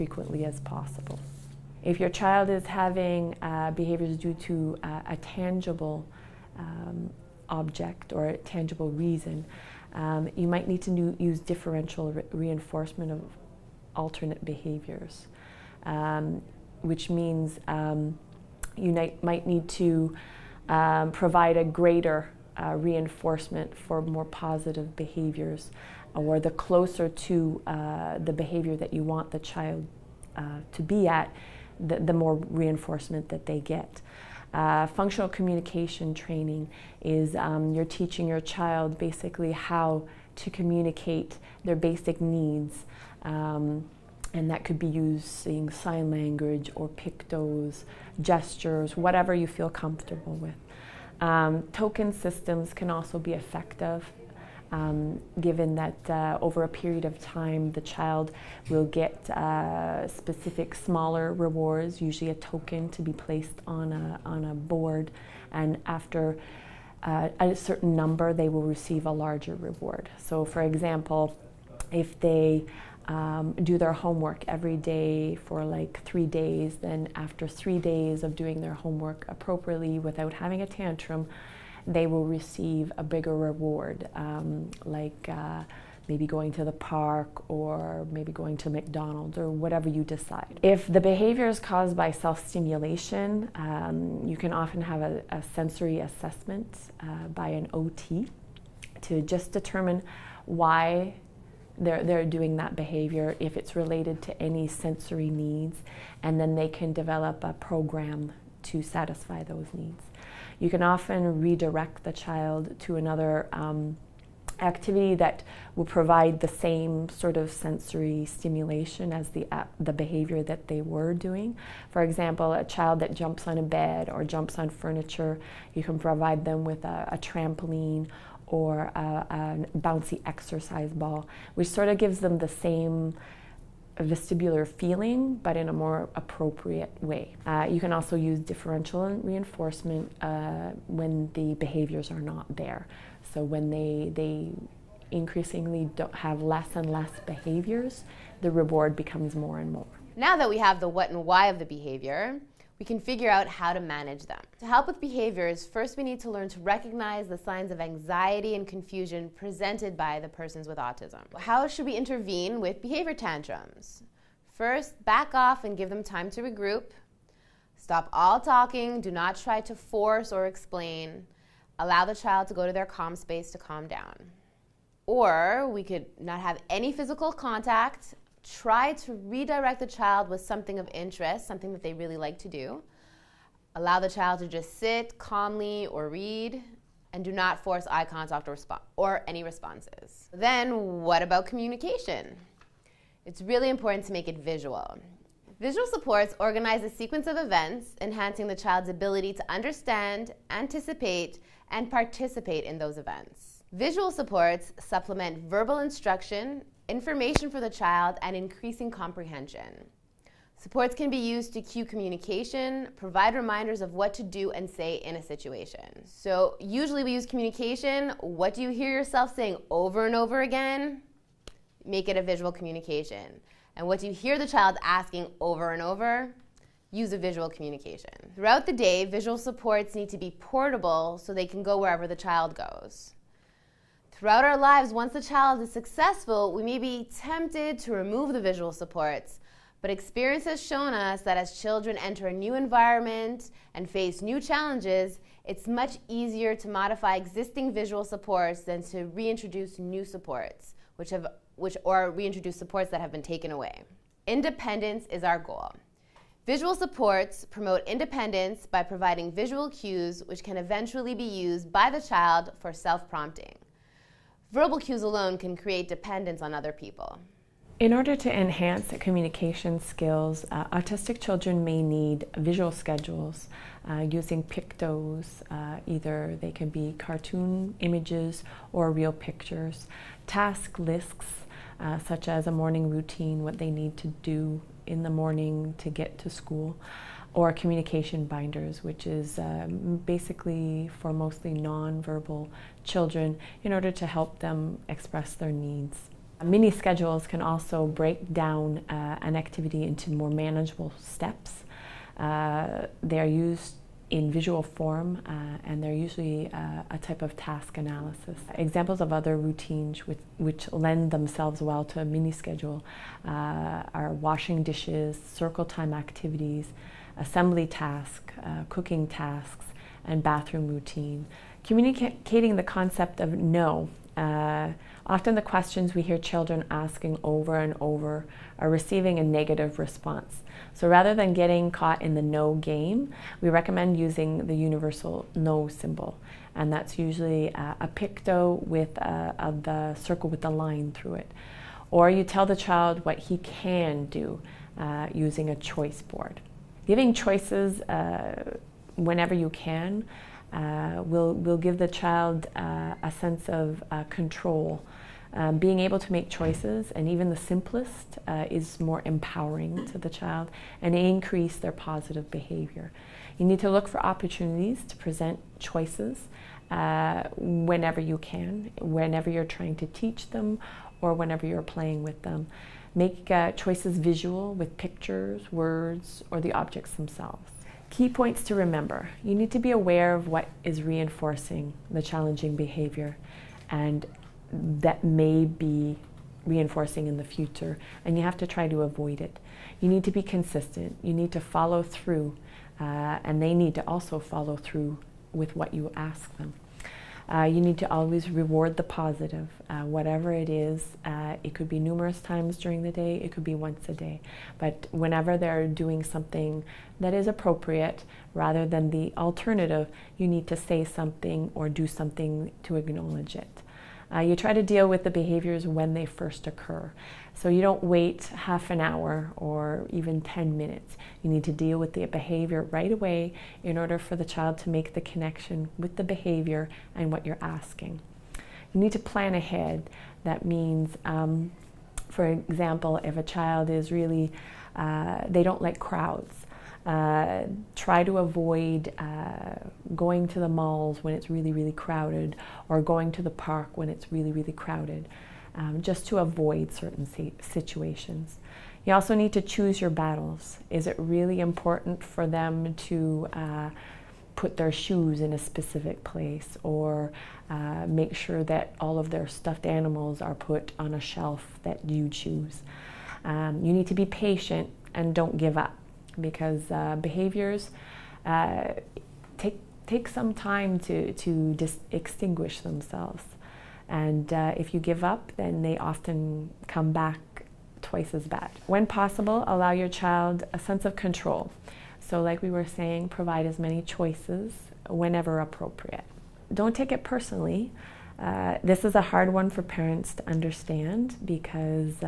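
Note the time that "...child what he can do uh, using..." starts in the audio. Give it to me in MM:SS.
05:42.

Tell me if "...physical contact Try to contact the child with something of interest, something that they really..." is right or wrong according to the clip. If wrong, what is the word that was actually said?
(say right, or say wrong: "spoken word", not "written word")
wrong: "redirect", not "contact".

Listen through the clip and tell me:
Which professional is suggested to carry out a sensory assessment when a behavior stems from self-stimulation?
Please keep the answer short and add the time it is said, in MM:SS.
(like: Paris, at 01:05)
OT, at 01:37.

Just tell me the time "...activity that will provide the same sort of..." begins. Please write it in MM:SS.
01:54.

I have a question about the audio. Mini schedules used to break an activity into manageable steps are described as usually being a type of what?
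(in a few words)
task analysis.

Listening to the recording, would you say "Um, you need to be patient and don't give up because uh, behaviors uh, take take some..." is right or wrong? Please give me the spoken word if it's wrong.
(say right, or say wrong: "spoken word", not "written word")
right.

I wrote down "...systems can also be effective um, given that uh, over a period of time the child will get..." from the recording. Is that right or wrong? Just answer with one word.
right.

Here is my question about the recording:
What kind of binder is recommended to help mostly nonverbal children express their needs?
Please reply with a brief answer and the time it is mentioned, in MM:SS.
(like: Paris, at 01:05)
communication binders, at 04:47.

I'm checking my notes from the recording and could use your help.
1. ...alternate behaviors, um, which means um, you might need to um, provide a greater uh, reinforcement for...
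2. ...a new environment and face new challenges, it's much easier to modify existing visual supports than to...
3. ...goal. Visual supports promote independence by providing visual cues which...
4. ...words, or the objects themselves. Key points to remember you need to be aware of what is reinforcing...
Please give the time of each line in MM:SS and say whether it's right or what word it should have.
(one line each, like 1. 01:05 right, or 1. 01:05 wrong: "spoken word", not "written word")
1. 00:13 right
2. 04:02 right
3. 04:15 right
4. 06:15 right.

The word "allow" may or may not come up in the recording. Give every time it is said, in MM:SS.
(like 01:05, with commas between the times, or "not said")
02:51, 03:03, 07:59.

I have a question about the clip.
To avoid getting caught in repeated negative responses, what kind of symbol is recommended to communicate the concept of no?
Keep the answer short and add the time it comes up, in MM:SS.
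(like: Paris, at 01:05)
universal no symbol, at 05:34.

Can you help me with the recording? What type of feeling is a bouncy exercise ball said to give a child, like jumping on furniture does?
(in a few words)
vestibular.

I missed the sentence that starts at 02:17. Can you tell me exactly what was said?
Uh, you can also use differential reinforcement uh, when the behaviors are not there.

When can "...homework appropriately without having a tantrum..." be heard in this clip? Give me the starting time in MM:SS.
01:18.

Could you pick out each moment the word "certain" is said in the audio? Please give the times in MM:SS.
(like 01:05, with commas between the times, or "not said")
01:07, 07:26.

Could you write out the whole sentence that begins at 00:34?
Uh, functional communication training is um, you're teaching your child basically how to communicate their basic needs.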